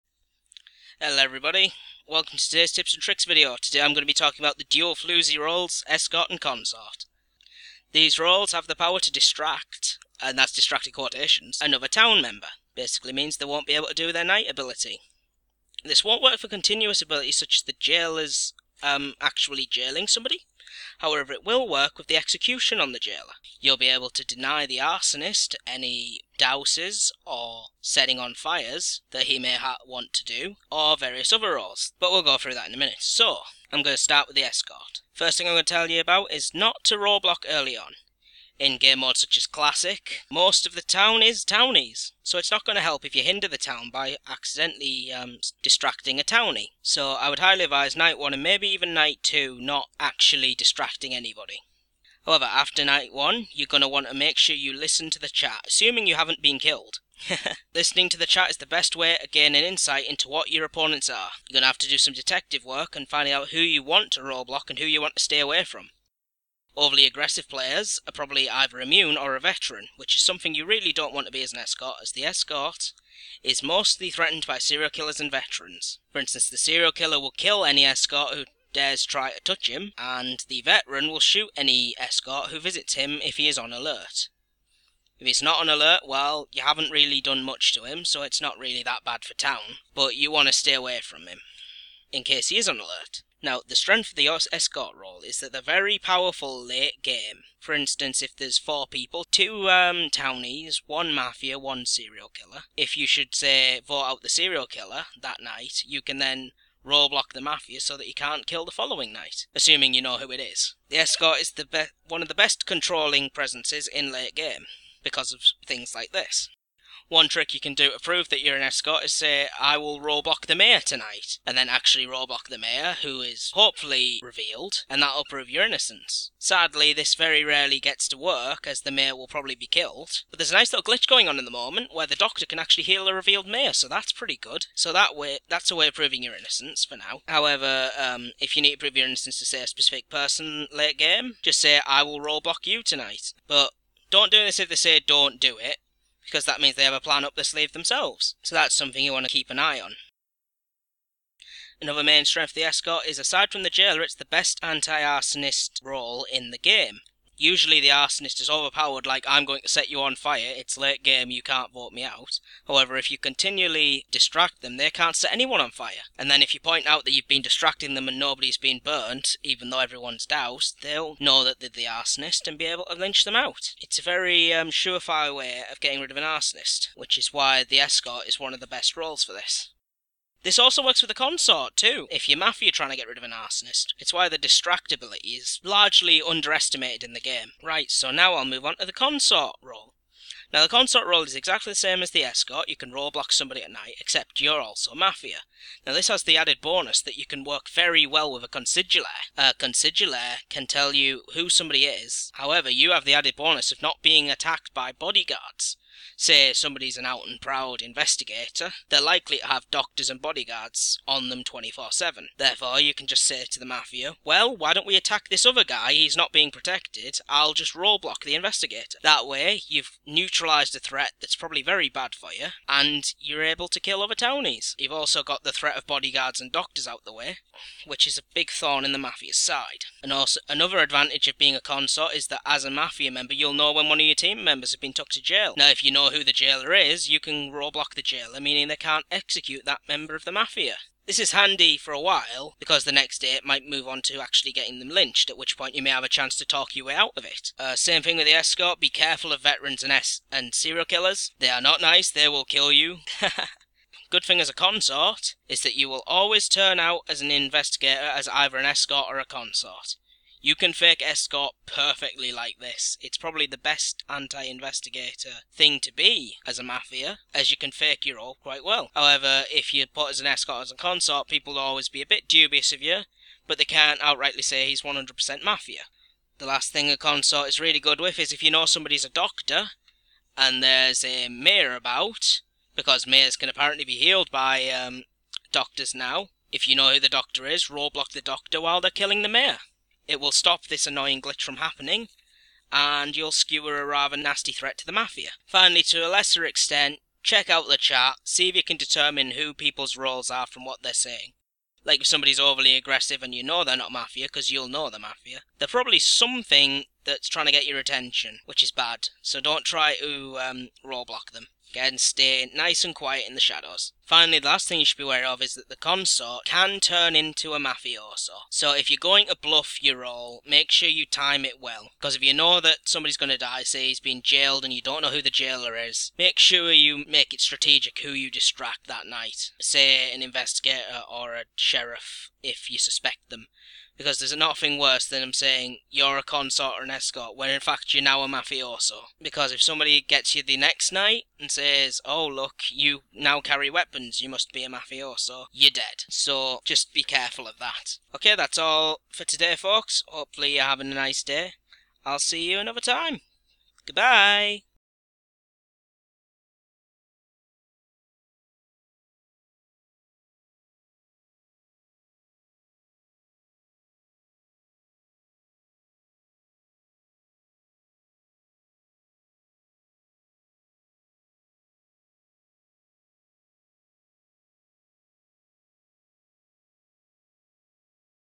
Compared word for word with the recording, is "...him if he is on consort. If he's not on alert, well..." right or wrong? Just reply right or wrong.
wrong.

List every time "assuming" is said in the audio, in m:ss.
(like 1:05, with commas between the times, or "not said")
0:55, 1:49.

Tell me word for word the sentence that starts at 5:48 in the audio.
Okay, that's all for today, folks.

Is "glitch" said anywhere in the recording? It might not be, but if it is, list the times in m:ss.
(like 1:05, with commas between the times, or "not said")
2:10, 4:51.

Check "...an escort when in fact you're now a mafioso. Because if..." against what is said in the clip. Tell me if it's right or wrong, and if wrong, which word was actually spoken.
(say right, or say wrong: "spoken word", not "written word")
right.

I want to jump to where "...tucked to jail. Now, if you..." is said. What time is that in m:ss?
3:54.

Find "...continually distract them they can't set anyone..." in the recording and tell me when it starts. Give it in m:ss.
2:43.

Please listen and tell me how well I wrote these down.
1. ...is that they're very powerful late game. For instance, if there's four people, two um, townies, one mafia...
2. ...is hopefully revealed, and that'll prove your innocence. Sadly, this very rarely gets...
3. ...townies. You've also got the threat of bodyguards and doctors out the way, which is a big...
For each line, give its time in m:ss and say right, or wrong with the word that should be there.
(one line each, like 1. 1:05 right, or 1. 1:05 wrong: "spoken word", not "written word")
1. 1:35 right
2. 2:03 right
3. 3:44 right.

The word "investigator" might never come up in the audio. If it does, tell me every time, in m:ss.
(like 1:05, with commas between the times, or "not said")
3:27, 3:38, 4:17, 4:24, 5:30.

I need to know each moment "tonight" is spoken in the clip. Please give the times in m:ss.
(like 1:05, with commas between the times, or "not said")
2:00, 2:22.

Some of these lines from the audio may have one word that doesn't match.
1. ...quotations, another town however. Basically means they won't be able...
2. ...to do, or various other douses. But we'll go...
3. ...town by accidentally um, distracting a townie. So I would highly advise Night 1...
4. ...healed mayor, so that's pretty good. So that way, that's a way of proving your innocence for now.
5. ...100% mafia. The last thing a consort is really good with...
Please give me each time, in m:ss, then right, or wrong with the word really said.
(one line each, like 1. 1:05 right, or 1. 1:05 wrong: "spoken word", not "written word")
1. 0:10 wrong: "member", not "however"
2. 0:30 wrong: "roles", not "douses"
3. 0:43 right
4. 2:13 wrong: "revealed", not "healed"
5. 4:34 right.